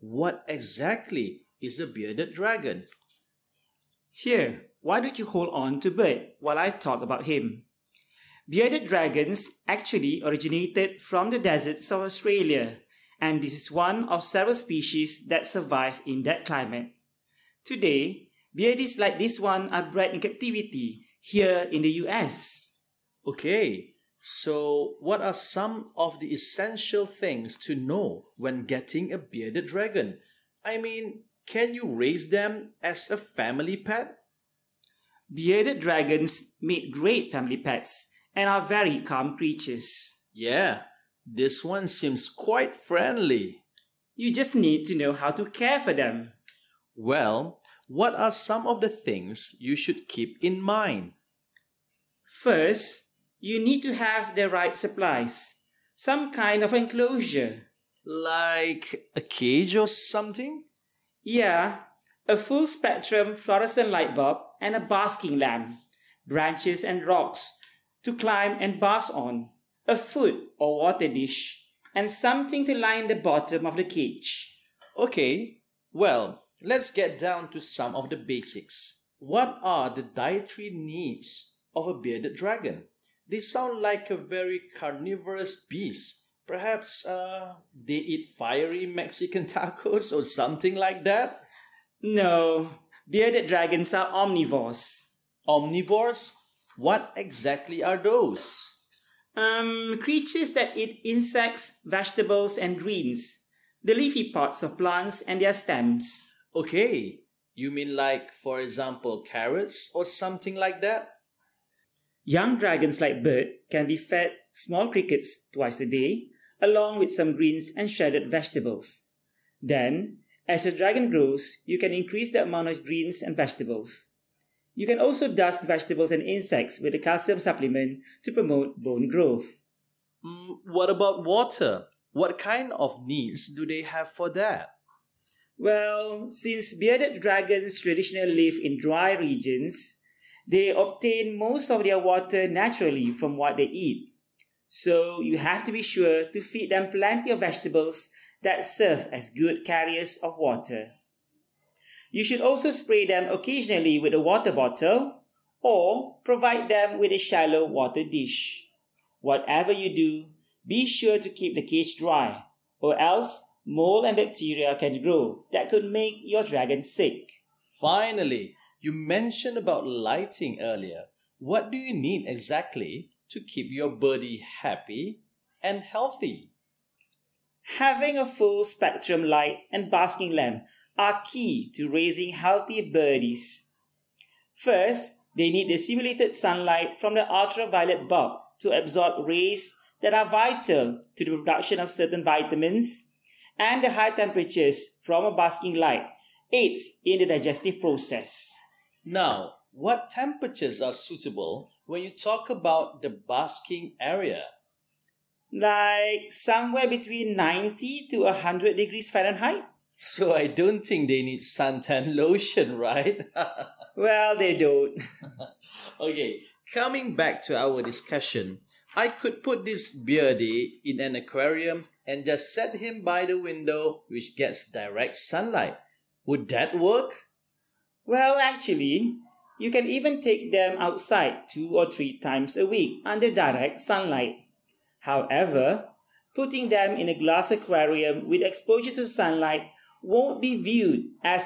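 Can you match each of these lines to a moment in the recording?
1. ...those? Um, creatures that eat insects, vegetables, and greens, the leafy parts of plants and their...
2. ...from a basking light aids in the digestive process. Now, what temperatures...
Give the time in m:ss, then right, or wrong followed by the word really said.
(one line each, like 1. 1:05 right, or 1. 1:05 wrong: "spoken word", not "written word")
1. 1:37 right
2. 3:15 right.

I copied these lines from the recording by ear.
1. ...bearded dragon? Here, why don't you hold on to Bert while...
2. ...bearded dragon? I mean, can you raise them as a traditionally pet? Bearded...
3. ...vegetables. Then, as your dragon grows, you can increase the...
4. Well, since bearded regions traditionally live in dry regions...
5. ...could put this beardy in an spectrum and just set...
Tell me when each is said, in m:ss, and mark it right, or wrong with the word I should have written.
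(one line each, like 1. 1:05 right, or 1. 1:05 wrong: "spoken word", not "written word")
1. 0:01 right
2. 0:29 wrong: "family", not "traditionally"
3. 1:58 right
4. 2:15 wrong: "dragons", not "regions"
5. 3:39 wrong: "aquarium", not "spectrum".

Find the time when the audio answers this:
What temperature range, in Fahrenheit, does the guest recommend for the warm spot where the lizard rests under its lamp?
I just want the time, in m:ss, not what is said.
3:27.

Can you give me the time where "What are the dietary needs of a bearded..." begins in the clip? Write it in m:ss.
1:19.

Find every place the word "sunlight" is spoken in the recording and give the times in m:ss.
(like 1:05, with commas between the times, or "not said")
3:06, 3:45, 3:53, 3:59.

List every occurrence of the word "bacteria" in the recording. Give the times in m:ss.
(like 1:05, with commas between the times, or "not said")
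2:44.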